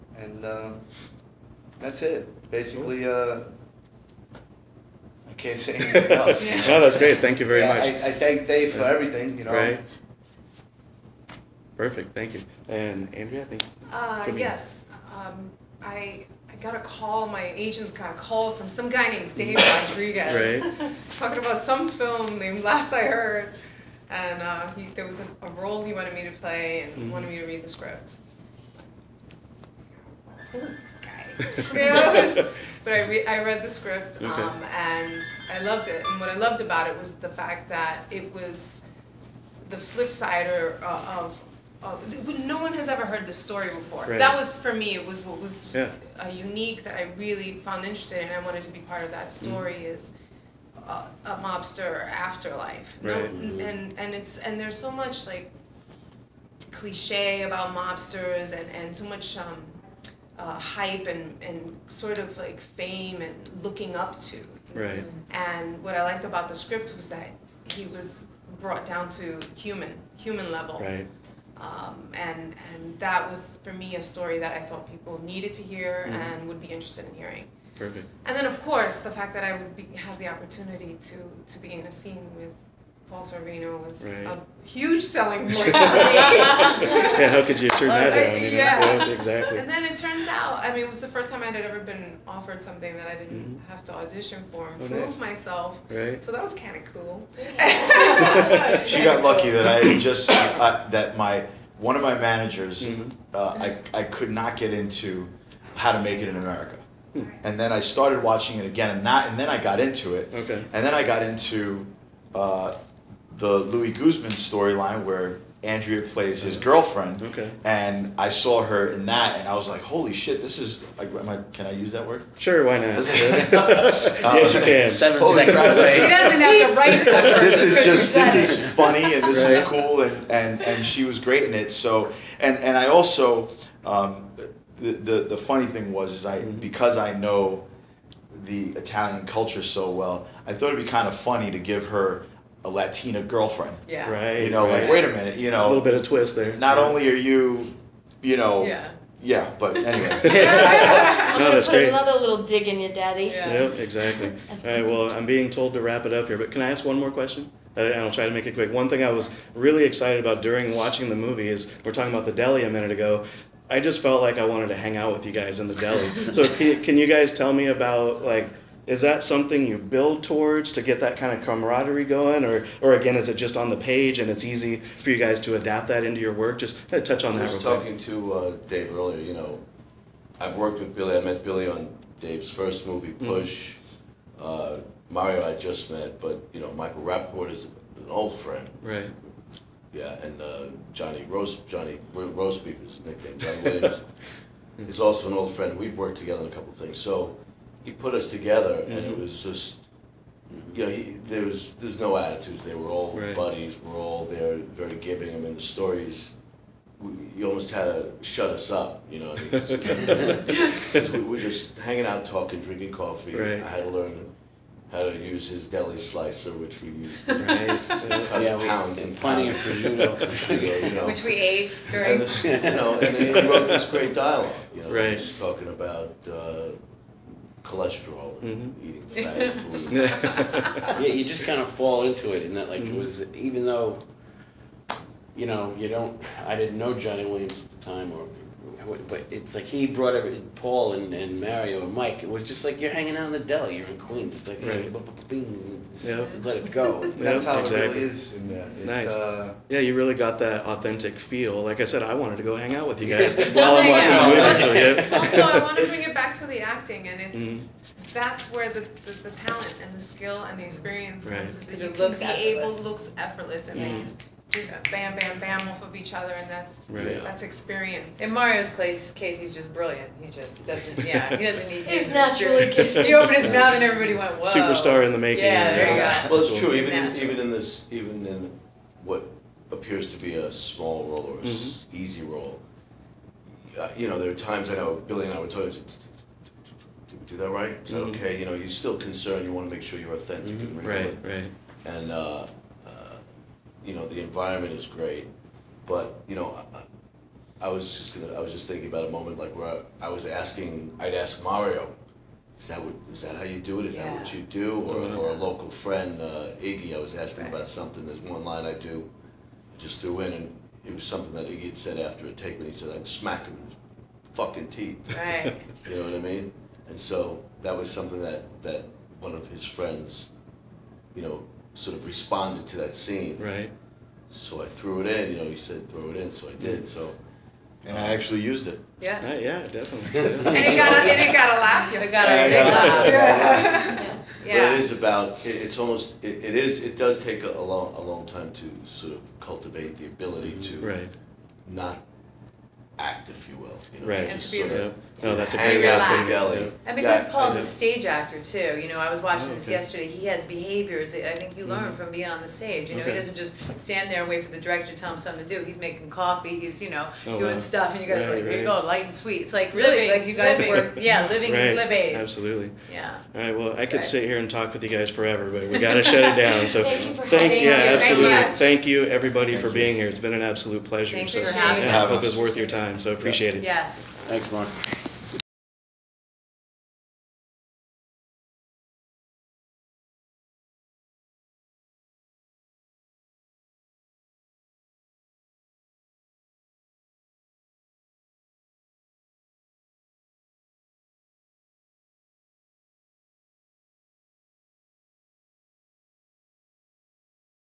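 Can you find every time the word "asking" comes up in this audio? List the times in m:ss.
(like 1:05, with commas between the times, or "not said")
5:00, 5:07.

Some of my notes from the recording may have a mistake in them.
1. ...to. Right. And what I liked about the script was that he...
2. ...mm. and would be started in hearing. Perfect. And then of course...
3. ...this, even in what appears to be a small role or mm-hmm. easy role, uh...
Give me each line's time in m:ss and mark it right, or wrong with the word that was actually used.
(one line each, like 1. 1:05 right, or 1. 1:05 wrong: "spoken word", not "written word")
1. 1:04 right
2. 1:16 wrong: "interested", not "started"
3. 4:37 right.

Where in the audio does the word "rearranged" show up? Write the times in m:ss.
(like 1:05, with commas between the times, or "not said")
not said.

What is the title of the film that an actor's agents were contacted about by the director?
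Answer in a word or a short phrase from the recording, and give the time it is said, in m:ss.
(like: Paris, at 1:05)
Last I Heard, at 0:22.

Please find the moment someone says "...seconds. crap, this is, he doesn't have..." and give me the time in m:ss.
2:05.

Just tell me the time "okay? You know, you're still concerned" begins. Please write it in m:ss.
4:48.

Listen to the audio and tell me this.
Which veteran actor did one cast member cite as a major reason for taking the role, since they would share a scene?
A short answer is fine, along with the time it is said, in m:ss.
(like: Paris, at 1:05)
Paul Sorvino, at 1:23.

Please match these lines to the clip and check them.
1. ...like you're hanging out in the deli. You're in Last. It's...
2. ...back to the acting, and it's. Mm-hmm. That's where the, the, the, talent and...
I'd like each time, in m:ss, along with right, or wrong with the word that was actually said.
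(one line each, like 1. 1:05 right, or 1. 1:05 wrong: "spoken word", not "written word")
1. 4:02 wrong: "Queens", not "Last"
2. 4:16 right.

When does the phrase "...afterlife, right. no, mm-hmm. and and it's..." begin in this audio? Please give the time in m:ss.
0:52.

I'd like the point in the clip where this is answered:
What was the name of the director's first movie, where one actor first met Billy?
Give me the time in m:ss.
3:03.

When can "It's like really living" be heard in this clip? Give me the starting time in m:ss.
5:59.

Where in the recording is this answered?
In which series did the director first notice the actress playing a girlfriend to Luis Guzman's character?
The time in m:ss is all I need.
1:45.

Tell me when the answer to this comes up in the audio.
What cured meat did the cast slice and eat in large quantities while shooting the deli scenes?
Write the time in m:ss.
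3:40.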